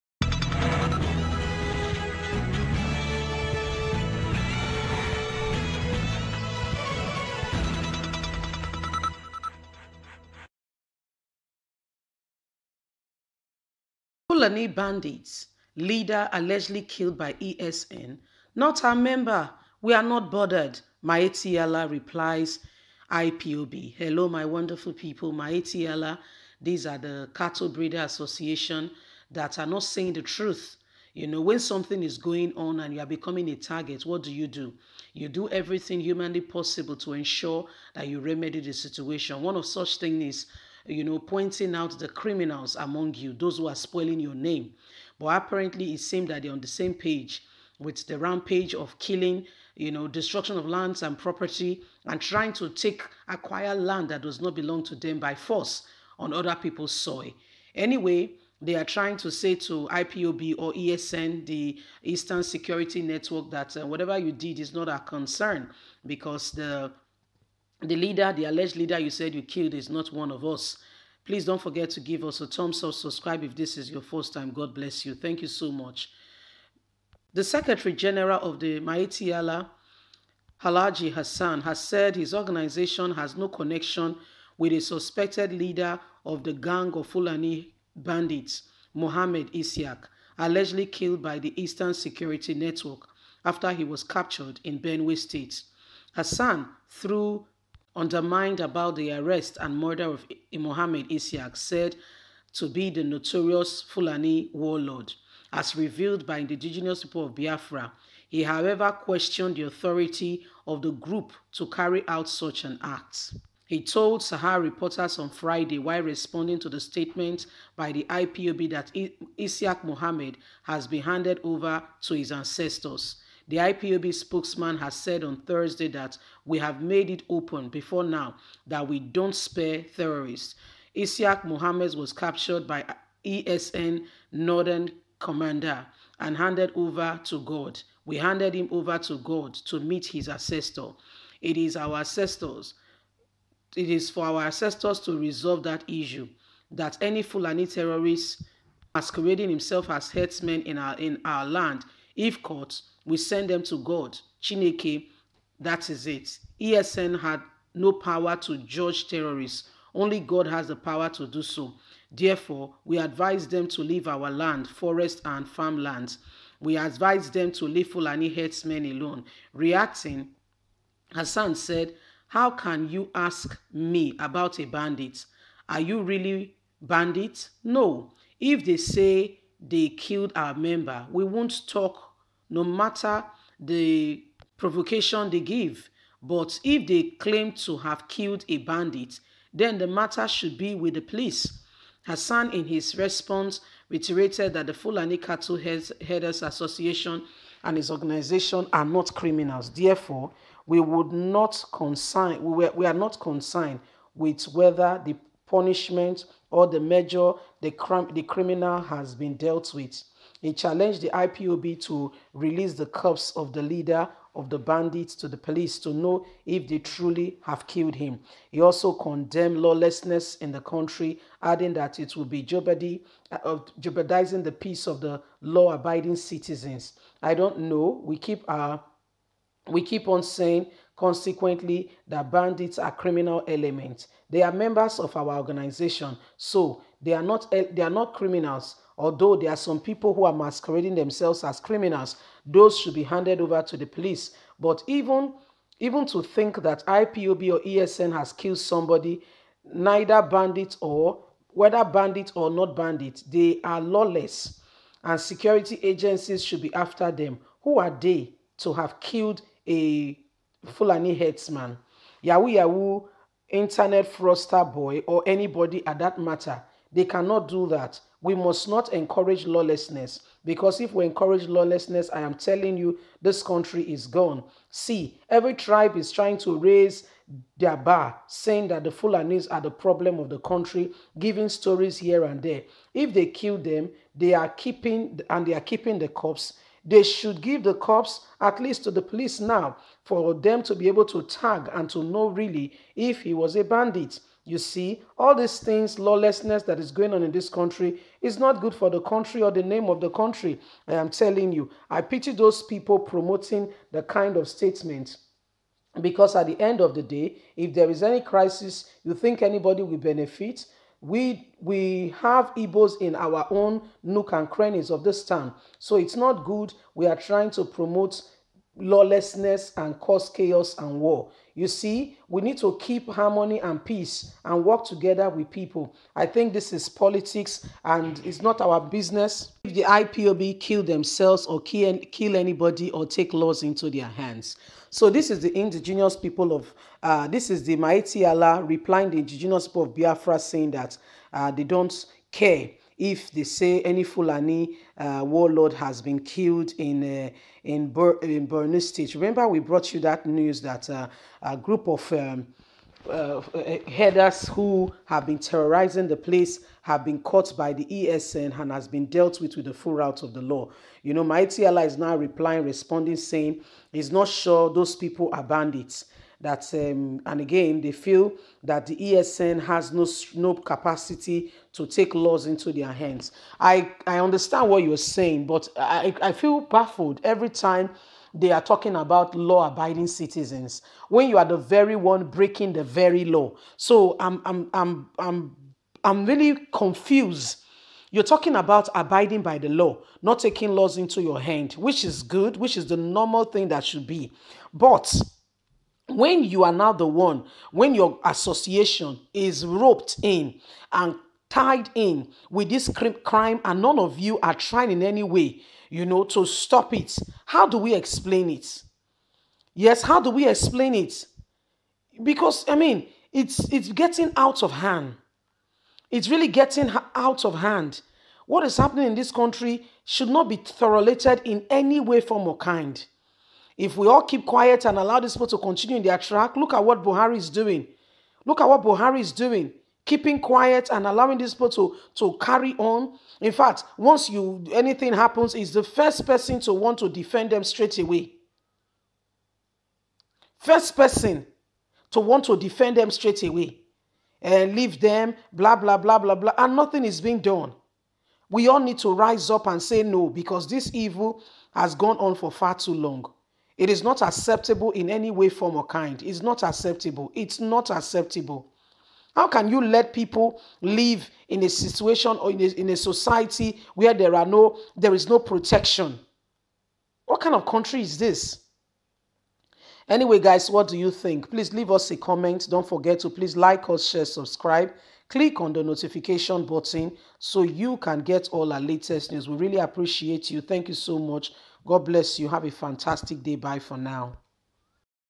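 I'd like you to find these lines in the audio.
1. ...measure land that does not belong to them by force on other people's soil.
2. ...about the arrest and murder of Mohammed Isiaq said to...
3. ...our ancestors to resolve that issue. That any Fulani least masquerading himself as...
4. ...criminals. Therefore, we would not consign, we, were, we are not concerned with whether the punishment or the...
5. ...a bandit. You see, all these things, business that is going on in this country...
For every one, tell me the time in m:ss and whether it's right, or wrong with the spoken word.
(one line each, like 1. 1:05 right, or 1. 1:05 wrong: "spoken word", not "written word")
1. 0:53 wrong: "acquire", not "measure"
2. 1:38 right
3. 2:24 wrong: "terrorist", not "least"
4. 3:19 right
5. 4:53 wrong: "lawlessness", not "business".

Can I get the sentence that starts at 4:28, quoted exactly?
We must not encourage lawlessness because if we encourage lawlessness, I am telling you, this country is gone.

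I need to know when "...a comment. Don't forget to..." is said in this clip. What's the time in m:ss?
7:52.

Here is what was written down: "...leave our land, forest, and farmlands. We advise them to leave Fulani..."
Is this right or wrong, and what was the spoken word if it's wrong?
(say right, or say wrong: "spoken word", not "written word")
right.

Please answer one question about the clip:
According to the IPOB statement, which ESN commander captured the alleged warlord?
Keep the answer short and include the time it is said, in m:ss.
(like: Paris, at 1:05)
ESN Northern Commander, at 2:13.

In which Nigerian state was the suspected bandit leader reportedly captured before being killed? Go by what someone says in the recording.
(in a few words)
Benue State.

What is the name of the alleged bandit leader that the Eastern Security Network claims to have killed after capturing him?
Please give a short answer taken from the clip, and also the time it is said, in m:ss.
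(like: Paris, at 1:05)
Mohammed Isiak, at 1:28.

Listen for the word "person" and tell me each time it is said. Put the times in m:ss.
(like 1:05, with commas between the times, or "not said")
7:16, 7:20.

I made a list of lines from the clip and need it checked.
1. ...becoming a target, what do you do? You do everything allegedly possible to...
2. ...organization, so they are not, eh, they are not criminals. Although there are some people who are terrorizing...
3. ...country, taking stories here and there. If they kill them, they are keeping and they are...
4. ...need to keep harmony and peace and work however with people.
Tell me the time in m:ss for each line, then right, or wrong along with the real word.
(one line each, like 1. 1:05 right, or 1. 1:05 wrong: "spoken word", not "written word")
1. 0:33 wrong: "humanly", not "allegedly"
2. 3:55 wrong: "masquerading", not "terrorizing"
3. 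4:40 wrong: "giving", not "taking"
4. 5:22 wrong: "together", not "however".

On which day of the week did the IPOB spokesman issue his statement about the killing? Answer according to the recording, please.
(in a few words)
Thursday.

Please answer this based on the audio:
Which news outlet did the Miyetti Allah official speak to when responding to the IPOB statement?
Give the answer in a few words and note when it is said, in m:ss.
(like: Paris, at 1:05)
Sahara Reporters, at 1:54.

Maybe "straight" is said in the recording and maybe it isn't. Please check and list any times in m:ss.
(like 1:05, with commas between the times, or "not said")
7:17, 7:23.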